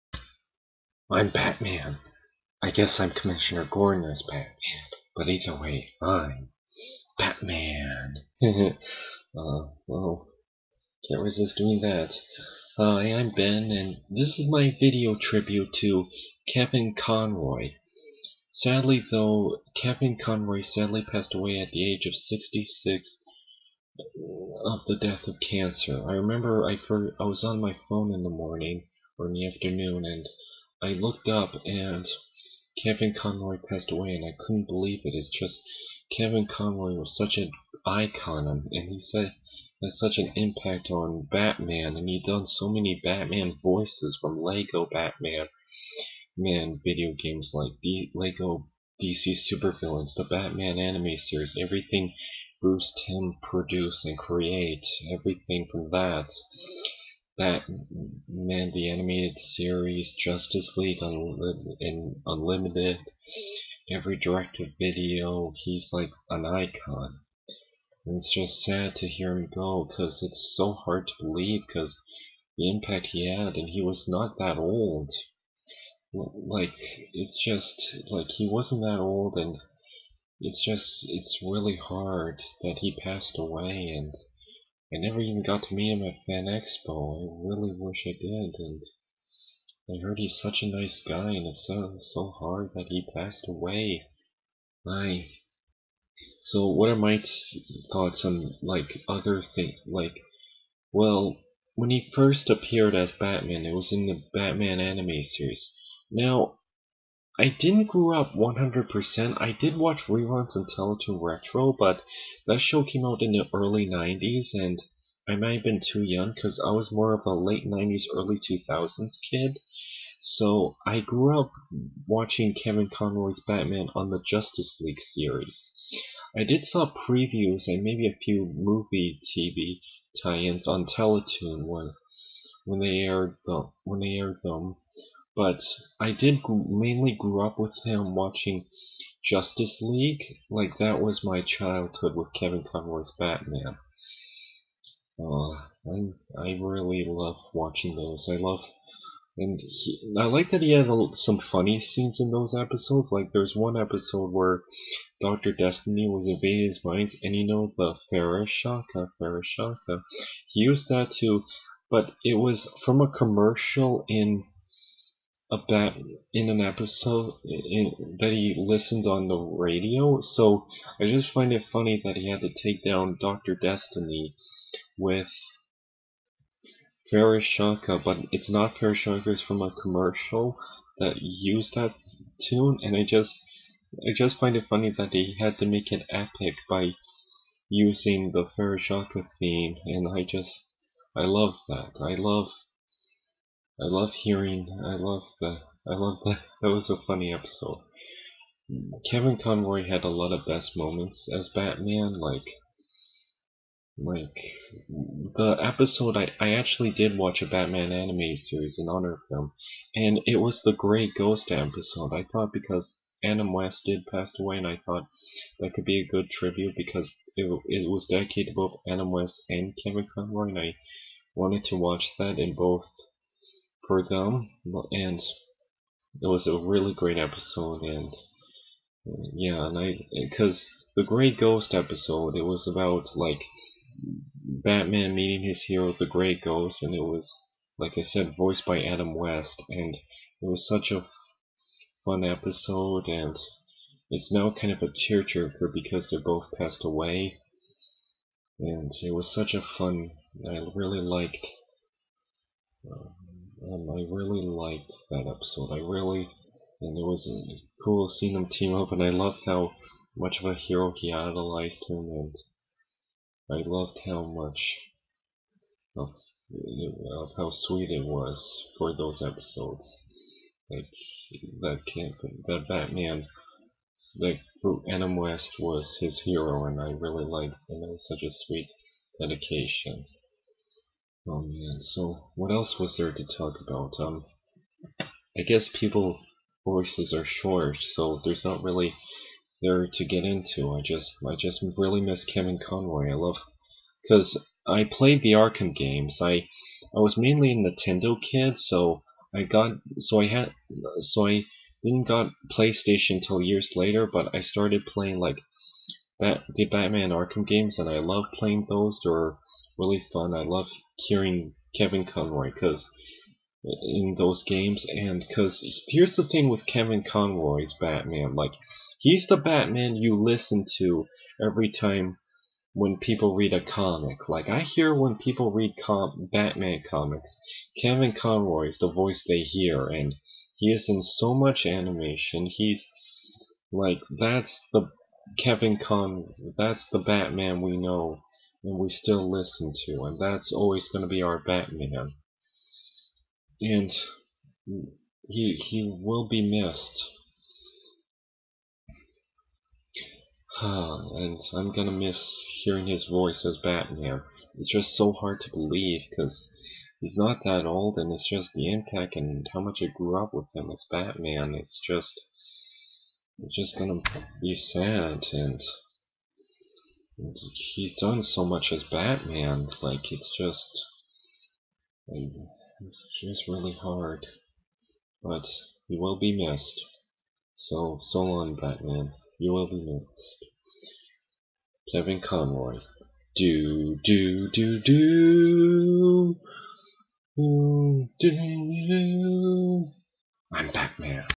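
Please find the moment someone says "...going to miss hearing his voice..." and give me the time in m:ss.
5:51.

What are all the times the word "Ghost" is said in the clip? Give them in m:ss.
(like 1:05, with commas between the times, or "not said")
3:31, 3:51, 3:56.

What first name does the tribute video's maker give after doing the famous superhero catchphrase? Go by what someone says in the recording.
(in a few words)
Ben.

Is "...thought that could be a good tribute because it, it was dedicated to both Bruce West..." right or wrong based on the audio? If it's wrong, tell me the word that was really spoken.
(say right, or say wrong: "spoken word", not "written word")
wrong: "Adam", not "Bruce".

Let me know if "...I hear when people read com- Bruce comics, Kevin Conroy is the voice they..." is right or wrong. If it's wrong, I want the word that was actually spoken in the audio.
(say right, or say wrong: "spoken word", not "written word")
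wrong: "Batman", not "Bruce".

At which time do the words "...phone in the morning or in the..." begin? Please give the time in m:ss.
0:27.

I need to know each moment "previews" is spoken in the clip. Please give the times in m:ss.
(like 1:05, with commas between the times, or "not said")
2:06.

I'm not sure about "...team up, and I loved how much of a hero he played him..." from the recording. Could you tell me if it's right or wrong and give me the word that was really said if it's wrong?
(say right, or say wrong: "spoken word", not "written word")
wrong: "idolized", not "played".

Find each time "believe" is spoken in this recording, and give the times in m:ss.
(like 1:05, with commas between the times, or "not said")
0:34, 1:11, 5:55.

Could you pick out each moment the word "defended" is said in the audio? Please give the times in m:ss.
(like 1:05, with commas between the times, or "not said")
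not said.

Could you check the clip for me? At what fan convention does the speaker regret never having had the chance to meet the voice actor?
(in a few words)
Fan Expo.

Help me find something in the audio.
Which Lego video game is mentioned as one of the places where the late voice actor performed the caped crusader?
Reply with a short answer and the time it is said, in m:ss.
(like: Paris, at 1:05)
Lego DC Supervillains, at 0:48.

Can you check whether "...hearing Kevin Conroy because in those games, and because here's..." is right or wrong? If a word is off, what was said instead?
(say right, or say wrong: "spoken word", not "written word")
right.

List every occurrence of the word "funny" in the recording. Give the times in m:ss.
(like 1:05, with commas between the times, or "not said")
2:31, 2:51, 3:04, 3:16.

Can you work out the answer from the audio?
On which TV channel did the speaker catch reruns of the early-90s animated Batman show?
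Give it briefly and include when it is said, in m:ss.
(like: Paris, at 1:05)
Teletoon Retro, at 1:50.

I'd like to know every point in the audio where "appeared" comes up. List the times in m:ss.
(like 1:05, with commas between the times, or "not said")
1:42.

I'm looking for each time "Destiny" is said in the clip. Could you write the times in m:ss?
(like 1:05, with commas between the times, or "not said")
2:35, 2:53.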